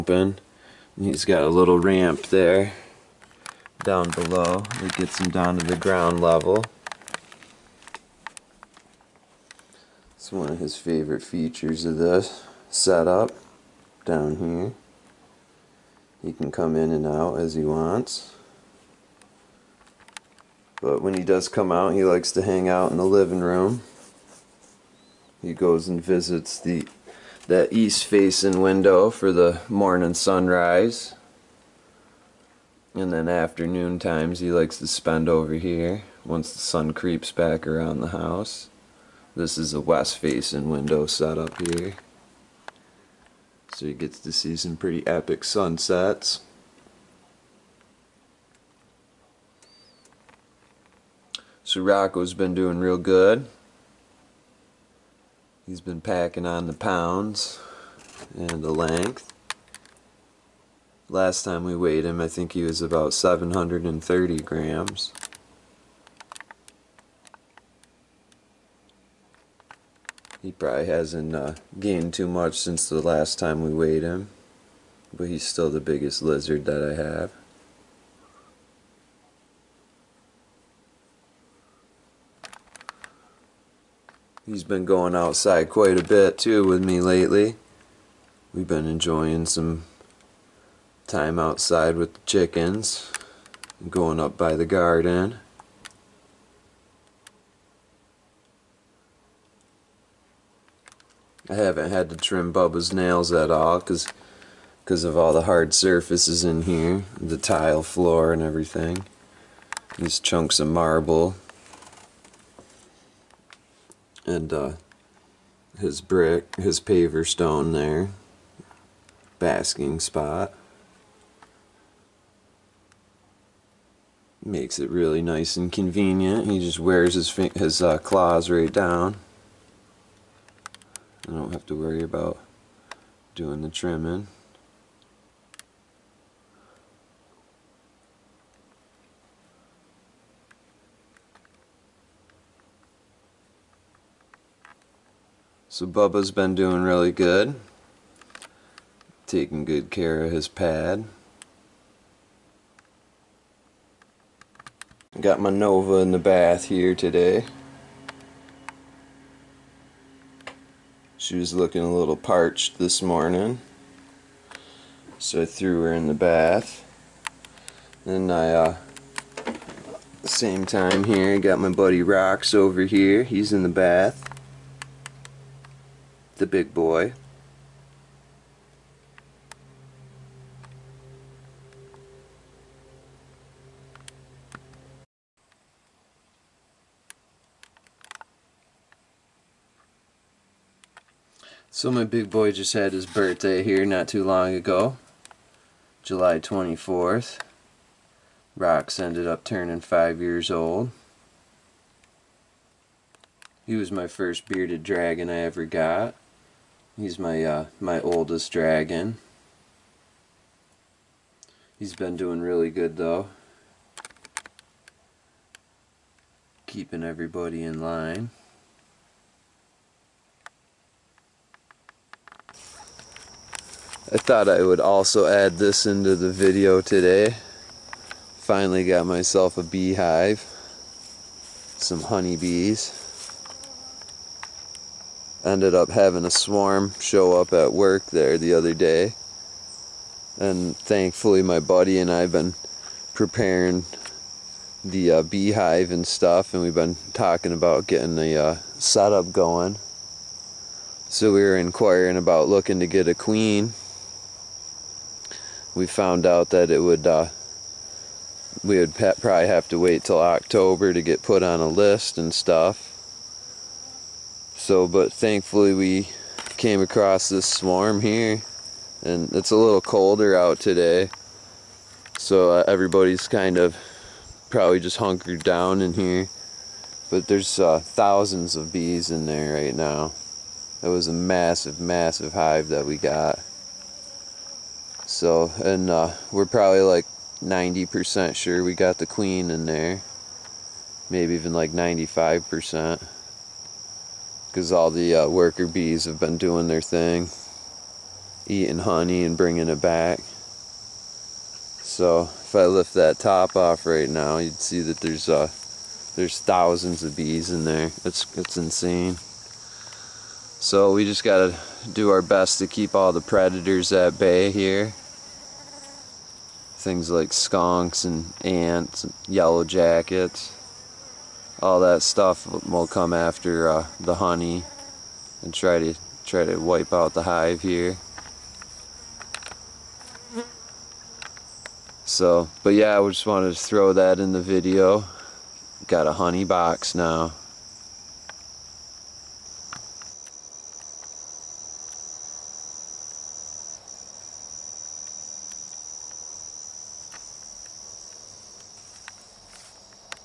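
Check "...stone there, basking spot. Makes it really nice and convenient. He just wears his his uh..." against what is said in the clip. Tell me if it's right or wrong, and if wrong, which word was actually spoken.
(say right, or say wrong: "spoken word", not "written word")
right.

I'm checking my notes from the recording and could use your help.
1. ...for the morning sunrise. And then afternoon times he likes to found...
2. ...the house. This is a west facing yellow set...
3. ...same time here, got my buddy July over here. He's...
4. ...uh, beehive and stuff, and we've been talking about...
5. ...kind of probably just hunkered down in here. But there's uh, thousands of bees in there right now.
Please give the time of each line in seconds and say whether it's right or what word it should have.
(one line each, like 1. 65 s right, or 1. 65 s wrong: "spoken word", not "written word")
1. 29 s wrong: "spend", not "found"
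2. 38 s wrong: "window", not "yellow"
3. 170 s wrong: "Rox", not "July"
4. 245 s right
5. 273 s right.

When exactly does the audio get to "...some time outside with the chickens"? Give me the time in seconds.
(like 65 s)
89 s.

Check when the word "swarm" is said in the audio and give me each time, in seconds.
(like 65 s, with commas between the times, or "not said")
236 s, 267 s.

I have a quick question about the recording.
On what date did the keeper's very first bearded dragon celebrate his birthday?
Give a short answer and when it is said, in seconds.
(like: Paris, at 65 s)
July 24th, at 196 s.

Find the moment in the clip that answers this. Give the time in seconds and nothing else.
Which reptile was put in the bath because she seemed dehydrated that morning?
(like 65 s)
155 s.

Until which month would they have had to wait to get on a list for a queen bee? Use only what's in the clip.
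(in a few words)
October.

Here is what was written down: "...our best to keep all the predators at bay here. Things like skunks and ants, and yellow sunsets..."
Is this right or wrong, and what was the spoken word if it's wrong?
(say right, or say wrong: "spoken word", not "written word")
wrong: "jackets", not "sunsets".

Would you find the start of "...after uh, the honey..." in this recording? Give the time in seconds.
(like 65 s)
323 s.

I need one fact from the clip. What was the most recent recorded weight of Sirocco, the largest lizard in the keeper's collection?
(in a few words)
730 grams.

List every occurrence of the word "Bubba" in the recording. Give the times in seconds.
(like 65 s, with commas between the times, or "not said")
102 s, 145 s.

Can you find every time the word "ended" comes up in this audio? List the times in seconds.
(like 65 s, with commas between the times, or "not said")
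199 s, 235 s.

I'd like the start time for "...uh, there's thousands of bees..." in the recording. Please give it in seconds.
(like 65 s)
305 s.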